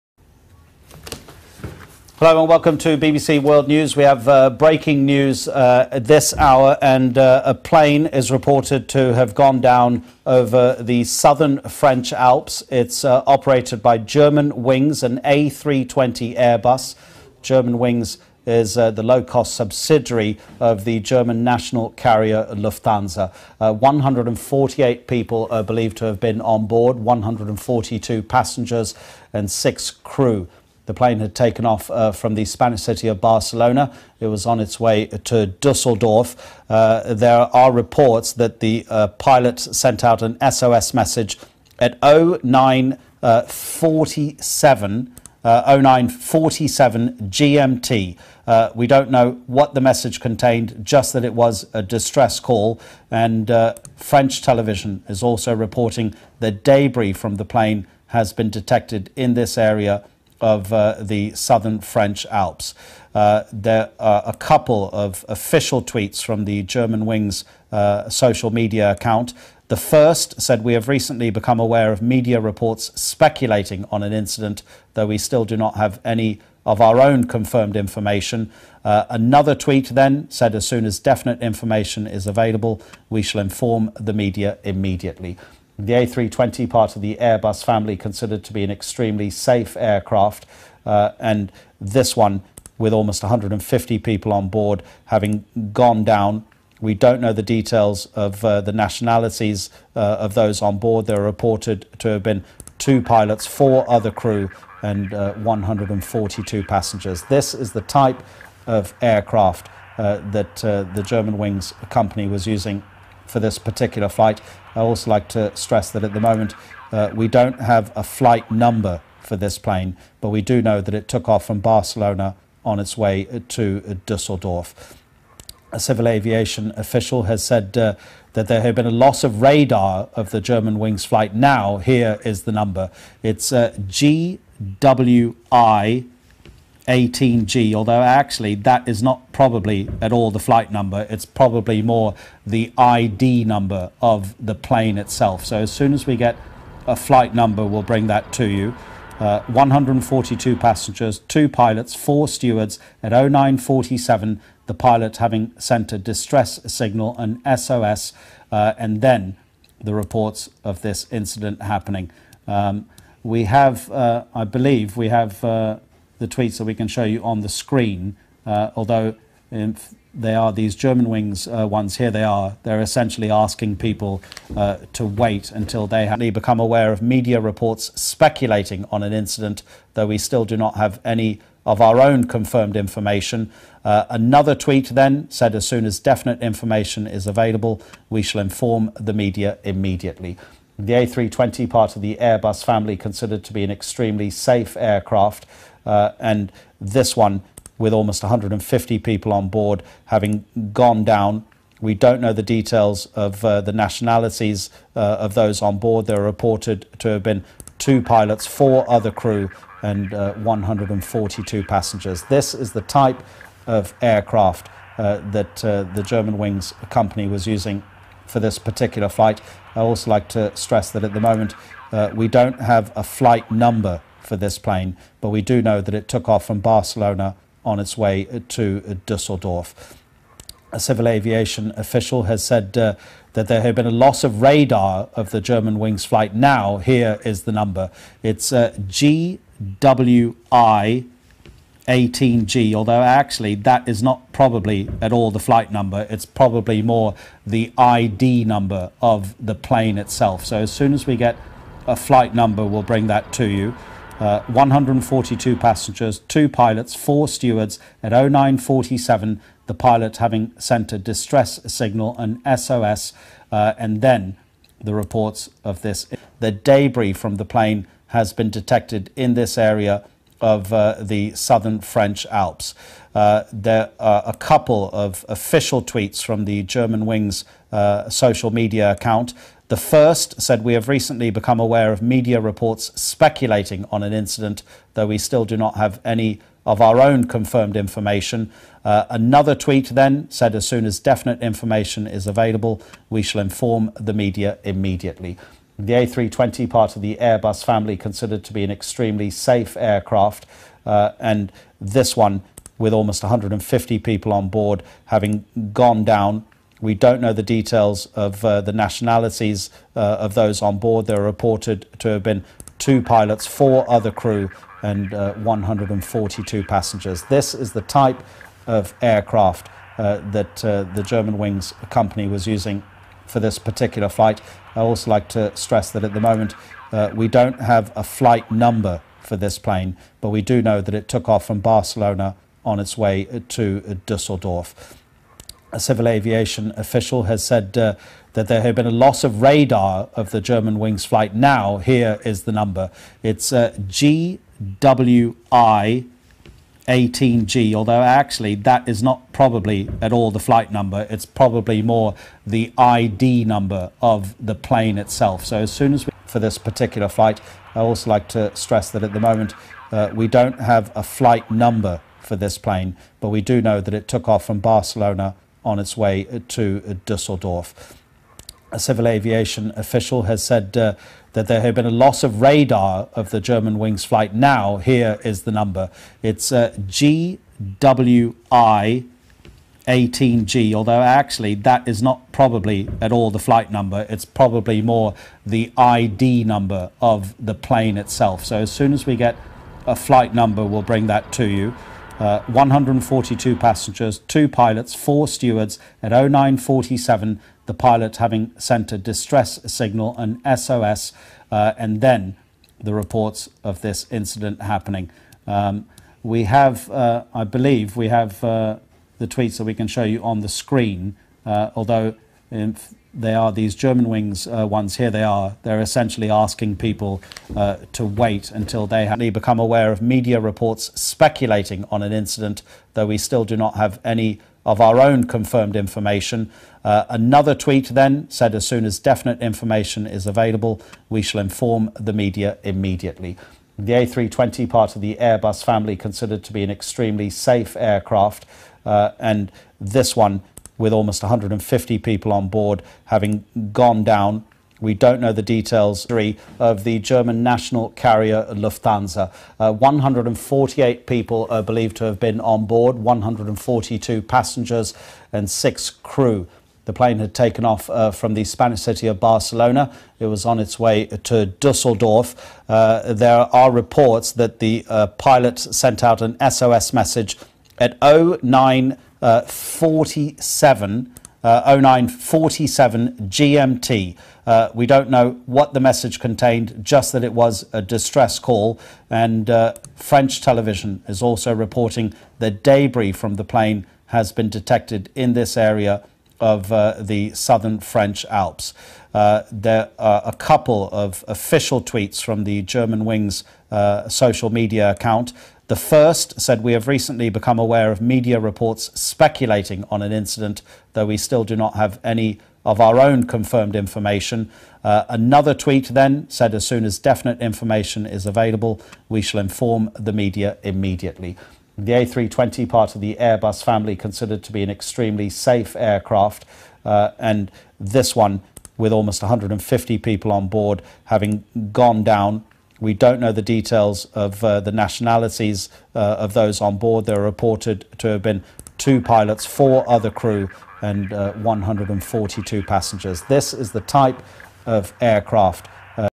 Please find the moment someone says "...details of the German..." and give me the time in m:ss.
7:25.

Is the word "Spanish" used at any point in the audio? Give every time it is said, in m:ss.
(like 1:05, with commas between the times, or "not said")
0:32, 7:38.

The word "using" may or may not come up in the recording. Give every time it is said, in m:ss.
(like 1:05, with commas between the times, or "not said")
1:52, 3:37, 5:22.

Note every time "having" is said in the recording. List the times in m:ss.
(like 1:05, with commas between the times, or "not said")
1:35, 2:35, 3:20, 4:20, 5:05, 6:38, 7:23, 8:41.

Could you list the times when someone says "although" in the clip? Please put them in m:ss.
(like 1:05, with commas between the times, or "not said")
2:17, 2:48, 4:02, 5:47, 6:20, 6:51.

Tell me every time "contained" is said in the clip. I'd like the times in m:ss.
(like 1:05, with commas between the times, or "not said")
0:50, 7:56.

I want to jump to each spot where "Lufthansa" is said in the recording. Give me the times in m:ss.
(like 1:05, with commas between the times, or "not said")
0:22, 7:28.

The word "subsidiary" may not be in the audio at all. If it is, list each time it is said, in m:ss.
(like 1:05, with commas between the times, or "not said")
0:19.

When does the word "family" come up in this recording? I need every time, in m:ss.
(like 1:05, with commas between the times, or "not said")
1:27, 3:12, 4:57, 7:15, 8:33.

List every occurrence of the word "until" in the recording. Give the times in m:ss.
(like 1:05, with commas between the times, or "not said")
2:55, 6:58.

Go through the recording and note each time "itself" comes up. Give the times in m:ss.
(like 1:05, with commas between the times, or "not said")
2:24, 4:09, 5:54, 6:27.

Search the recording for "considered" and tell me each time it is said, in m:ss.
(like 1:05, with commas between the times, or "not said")
1:27, 3:12, 4:57, 7:15, 8:33.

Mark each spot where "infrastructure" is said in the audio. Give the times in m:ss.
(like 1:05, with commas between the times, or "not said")
not said.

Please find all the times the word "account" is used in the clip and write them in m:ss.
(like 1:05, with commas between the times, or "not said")
1:08, 4:38, 8:14.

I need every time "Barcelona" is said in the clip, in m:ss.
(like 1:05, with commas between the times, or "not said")
0:33, 2:01, 3:46, 5:31, 6:04, 7:39.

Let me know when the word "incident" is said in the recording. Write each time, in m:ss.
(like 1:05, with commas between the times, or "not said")
1:14, 2:41, 2:59, 4:44, 6:44, 7:02, 8:20.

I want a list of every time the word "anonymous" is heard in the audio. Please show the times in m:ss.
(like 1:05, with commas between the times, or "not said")
not said.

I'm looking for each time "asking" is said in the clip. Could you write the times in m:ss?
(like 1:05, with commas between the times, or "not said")
2:53, 6:56.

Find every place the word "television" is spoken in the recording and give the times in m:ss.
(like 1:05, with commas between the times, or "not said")
0:54, 8:00.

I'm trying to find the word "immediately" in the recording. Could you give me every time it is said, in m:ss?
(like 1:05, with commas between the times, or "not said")
1:24, 3:09, 4:54, 7:12, 8:30.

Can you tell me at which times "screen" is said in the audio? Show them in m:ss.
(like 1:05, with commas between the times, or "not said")
2:47, 6:50.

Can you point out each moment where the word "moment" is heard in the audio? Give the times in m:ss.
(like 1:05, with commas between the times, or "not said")
1:56, 3:41, 5:26, 5:59.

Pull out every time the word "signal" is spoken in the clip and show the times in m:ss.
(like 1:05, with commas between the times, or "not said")
2:36, 4:21, 6:39.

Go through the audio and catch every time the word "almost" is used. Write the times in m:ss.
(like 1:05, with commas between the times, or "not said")
1:32, 3:17, 5:02, 7:20, 8:38.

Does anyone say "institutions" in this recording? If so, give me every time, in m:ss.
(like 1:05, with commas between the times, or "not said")
not said.